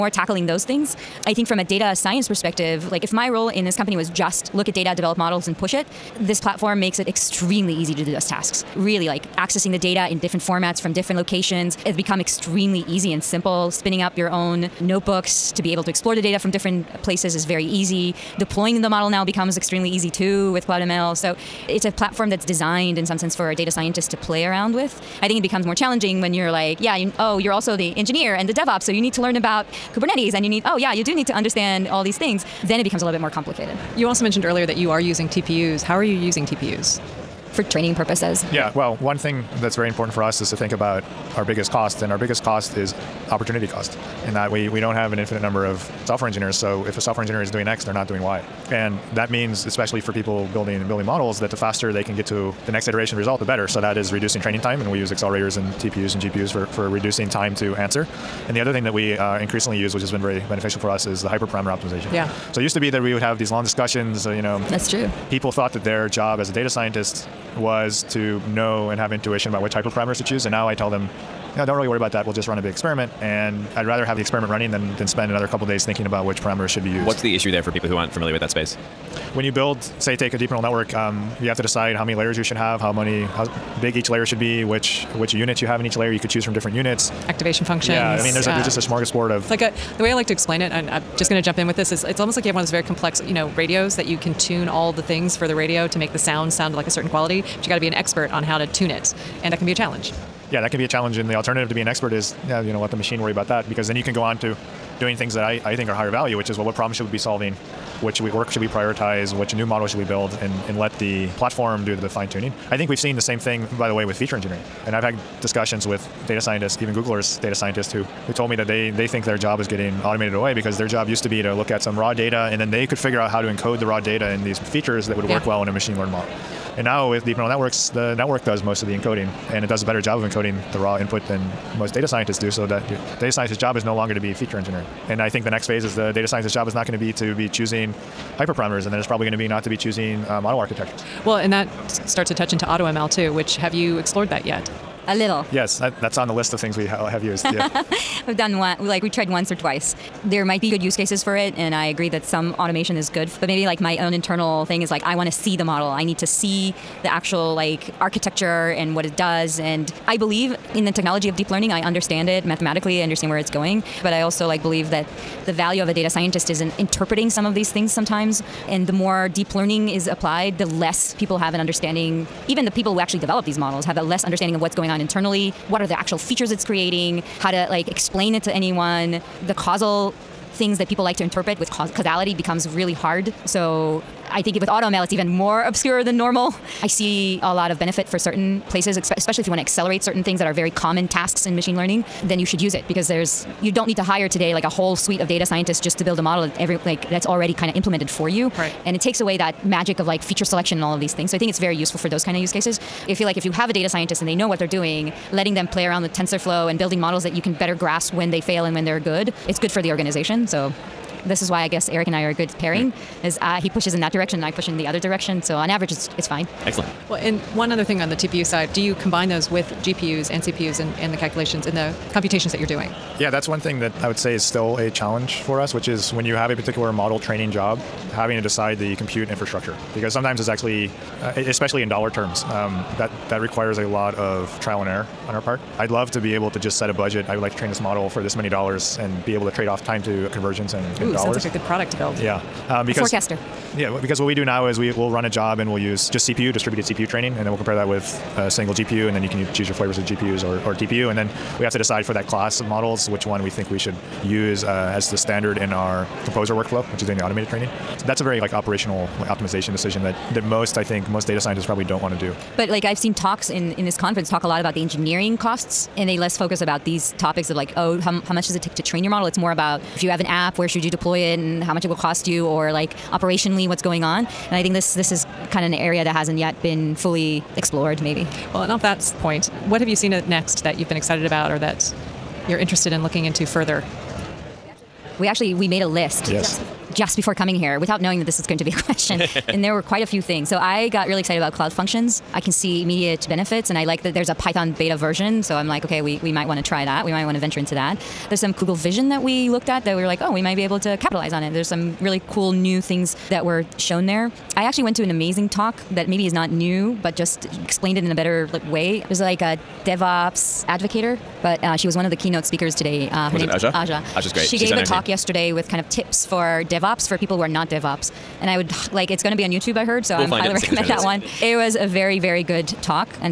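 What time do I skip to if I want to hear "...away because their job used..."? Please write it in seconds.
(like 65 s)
120 s.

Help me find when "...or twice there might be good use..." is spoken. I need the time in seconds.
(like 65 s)
149 s.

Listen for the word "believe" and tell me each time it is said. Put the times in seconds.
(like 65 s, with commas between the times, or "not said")
160 s, 164 s.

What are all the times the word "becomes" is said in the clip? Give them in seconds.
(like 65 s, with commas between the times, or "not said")
11 s, 19 s, 25 s, 32 s, 182 s.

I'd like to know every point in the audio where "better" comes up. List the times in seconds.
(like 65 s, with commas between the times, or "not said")
53 s, 129 s, 207 s, 308 s.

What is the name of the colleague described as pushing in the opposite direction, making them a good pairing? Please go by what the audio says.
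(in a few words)
Erik.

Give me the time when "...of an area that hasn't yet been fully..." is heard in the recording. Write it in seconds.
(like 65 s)
275 s.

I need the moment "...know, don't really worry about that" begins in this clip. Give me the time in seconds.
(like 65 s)
71 s.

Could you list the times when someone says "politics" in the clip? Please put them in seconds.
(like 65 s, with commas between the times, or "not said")
not said.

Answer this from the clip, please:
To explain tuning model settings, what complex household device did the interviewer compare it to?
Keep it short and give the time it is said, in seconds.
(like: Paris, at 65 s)
radio, at 93 s.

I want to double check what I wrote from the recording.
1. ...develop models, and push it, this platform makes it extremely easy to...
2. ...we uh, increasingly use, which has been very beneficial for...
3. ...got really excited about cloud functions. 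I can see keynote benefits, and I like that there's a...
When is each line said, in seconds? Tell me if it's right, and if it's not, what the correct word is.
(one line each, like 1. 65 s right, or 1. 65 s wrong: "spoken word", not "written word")
1. 4 s right
2. 58 s right
3. 290 s wrong: "immediate", not "keynote".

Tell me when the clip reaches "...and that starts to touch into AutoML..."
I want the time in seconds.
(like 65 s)
141 s.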